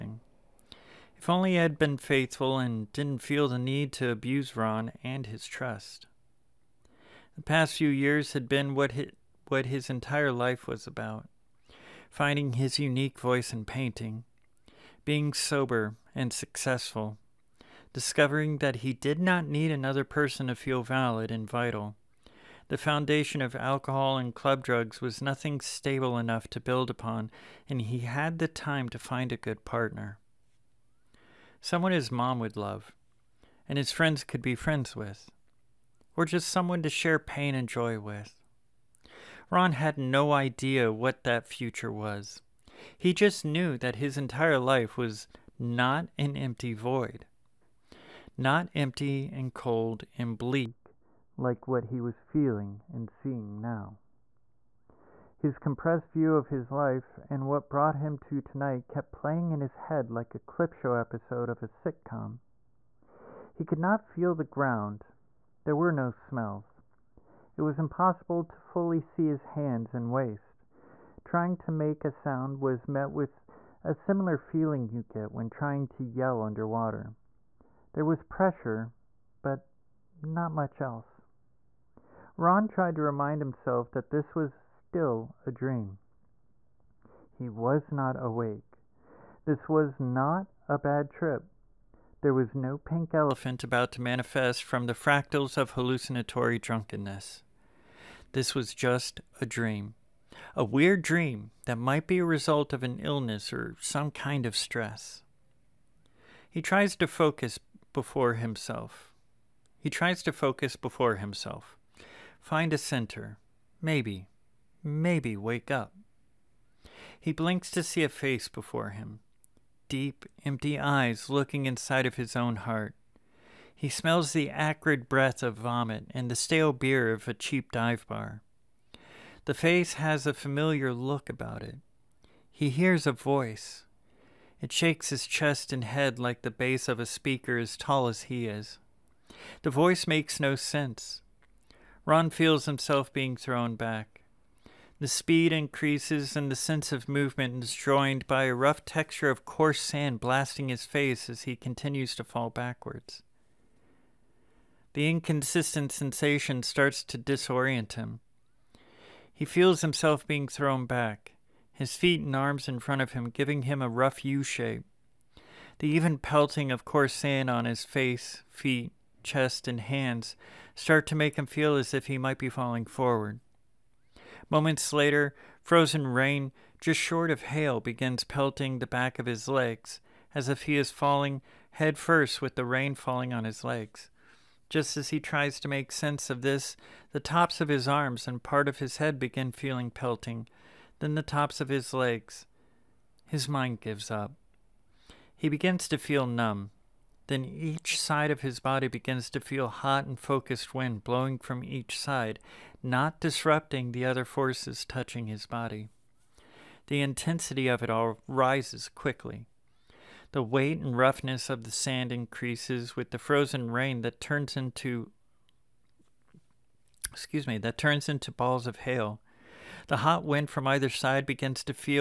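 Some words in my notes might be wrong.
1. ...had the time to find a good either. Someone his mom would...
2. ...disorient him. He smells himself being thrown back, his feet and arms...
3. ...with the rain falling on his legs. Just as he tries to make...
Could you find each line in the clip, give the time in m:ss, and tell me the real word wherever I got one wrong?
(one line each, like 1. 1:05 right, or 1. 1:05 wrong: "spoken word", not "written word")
1. 0:27 wrong: "partner", not "either"
2. 2:37 wrong: "feels", not "smells"
3. 3:02 right.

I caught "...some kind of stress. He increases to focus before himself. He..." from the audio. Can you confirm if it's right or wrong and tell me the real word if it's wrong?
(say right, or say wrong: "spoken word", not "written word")
wrong: "tries", not "increases".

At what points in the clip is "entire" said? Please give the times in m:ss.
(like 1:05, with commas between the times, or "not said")
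0:09, 0:44.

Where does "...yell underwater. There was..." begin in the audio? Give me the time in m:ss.
1:16.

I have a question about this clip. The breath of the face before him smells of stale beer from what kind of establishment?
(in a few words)
A cheap dive bar.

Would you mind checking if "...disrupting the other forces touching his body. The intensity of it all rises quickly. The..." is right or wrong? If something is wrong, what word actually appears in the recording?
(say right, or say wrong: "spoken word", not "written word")
right.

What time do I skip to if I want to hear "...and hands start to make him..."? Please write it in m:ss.
2:49.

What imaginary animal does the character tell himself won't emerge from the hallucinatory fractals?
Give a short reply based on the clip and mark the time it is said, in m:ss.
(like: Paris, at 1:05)
Pink elephant, at 1:32.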